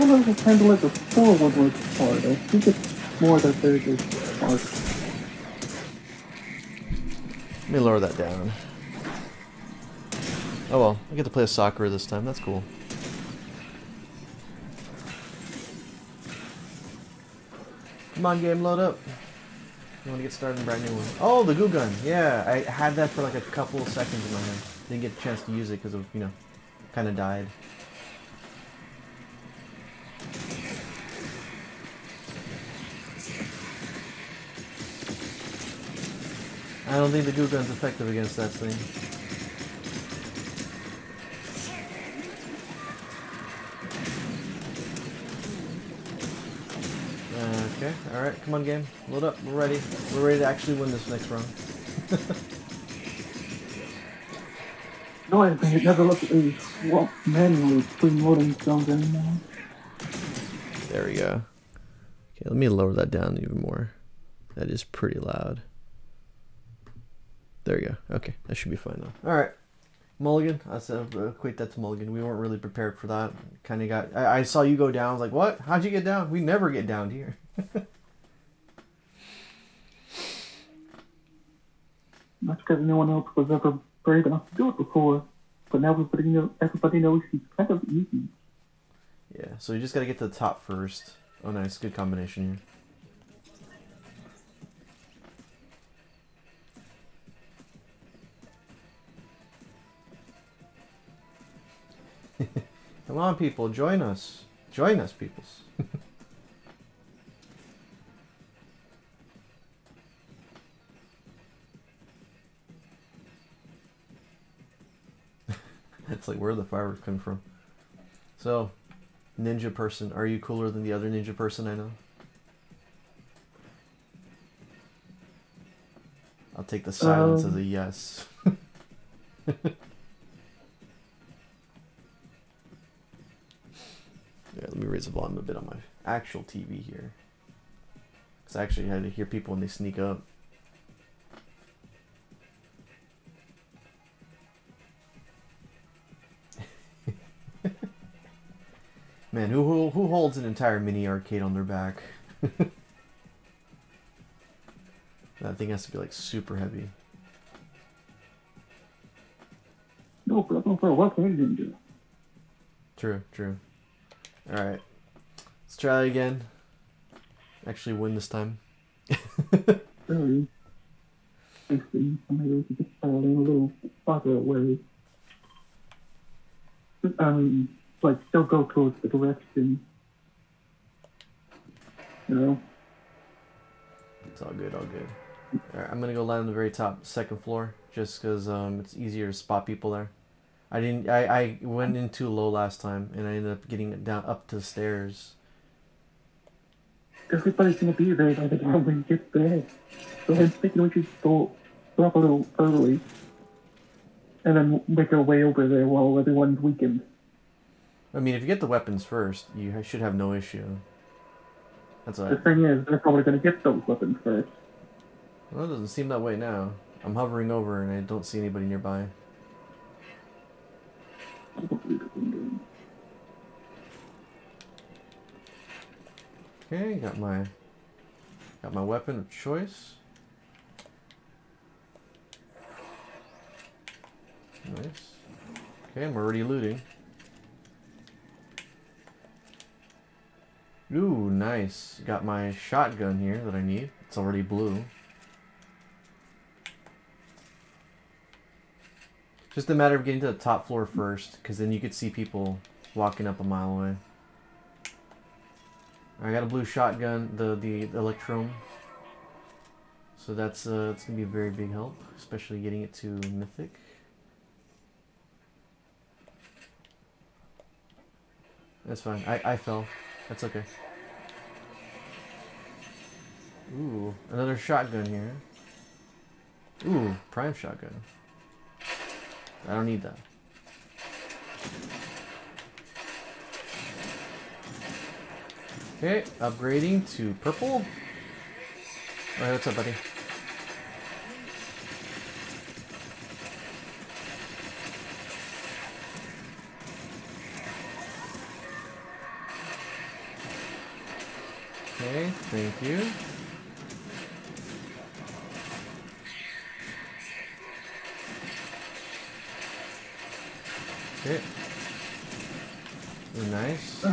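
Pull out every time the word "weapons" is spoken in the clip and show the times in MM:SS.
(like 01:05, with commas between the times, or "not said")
03:28, 03:33, 03:48.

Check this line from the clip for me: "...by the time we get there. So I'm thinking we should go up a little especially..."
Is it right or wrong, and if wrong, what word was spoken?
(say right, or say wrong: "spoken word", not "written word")
wrong: "early", not "especially".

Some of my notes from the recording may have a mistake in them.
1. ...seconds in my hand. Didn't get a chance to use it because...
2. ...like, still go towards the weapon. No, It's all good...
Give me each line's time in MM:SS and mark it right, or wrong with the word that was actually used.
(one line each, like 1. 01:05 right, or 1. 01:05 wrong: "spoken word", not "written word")
1. 00:23 right
2. 02:58 wrong: "direction", not "weapon".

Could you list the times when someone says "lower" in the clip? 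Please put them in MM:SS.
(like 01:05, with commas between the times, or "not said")
00:07, 01:02.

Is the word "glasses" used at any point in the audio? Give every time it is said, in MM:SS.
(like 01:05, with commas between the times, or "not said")
not said.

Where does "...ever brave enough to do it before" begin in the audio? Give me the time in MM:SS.
01:23.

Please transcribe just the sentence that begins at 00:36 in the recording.
I don't think the goo gun's effective against that thing.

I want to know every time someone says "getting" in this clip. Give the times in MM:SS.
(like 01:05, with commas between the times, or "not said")
03:13, 04:10, 04:22.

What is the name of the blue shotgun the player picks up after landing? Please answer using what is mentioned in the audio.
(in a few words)
Electrum.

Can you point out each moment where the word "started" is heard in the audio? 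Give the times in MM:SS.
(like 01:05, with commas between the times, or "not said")
00:20.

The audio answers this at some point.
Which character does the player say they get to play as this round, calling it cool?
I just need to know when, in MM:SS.
00:11.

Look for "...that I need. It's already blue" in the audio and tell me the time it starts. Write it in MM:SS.
04:03.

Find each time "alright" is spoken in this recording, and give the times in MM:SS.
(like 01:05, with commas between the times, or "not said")
00:48, 03:05, 04:49.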